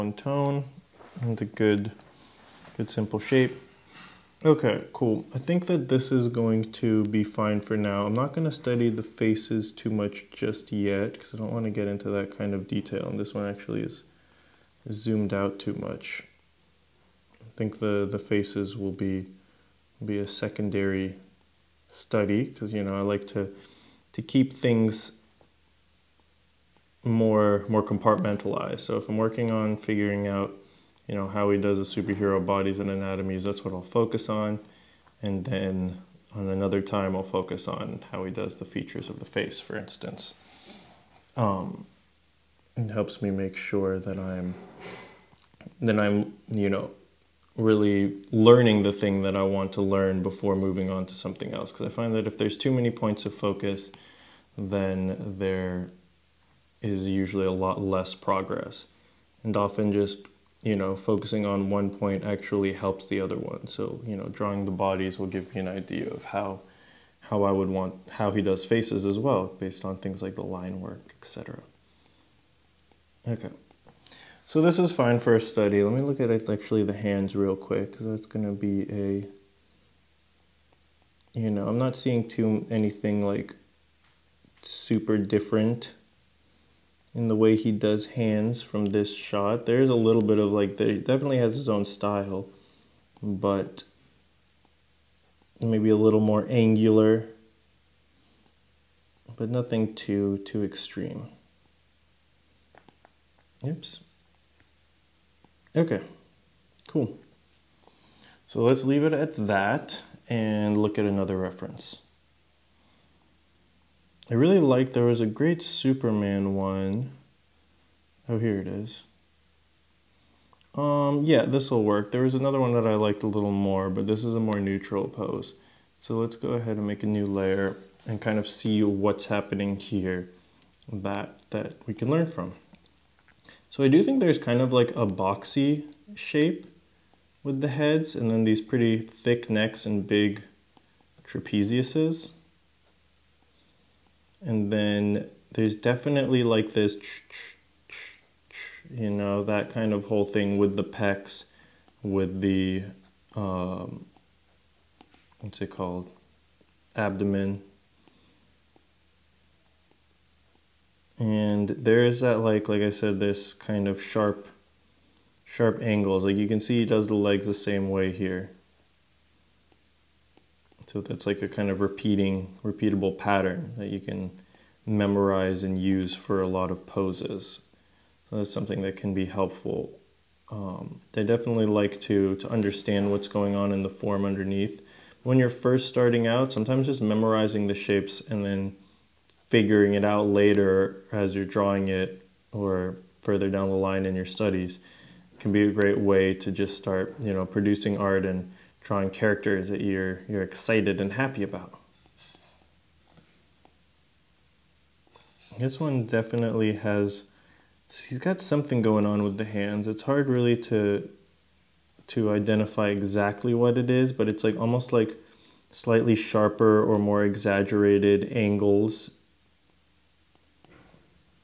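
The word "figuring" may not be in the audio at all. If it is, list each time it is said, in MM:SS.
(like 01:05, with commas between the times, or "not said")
00:29, 03:09.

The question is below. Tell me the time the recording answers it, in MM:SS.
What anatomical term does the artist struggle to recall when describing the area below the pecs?
02:36.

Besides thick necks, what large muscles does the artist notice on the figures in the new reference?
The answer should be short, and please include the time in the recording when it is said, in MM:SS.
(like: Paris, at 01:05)
trapeziuses, at 02:21.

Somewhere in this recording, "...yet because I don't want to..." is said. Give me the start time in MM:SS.
00:10.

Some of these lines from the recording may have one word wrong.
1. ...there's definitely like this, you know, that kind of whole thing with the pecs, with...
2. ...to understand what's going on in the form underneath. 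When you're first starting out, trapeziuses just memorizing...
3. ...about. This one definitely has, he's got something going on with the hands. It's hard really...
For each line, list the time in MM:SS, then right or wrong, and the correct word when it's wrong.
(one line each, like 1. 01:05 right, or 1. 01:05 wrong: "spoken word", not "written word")
1. 02:25 right
2. 03:02 wrong: "sometimes", not "trapeziuses"
3. 03:21 right.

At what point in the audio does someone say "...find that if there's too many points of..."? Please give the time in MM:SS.
00:51.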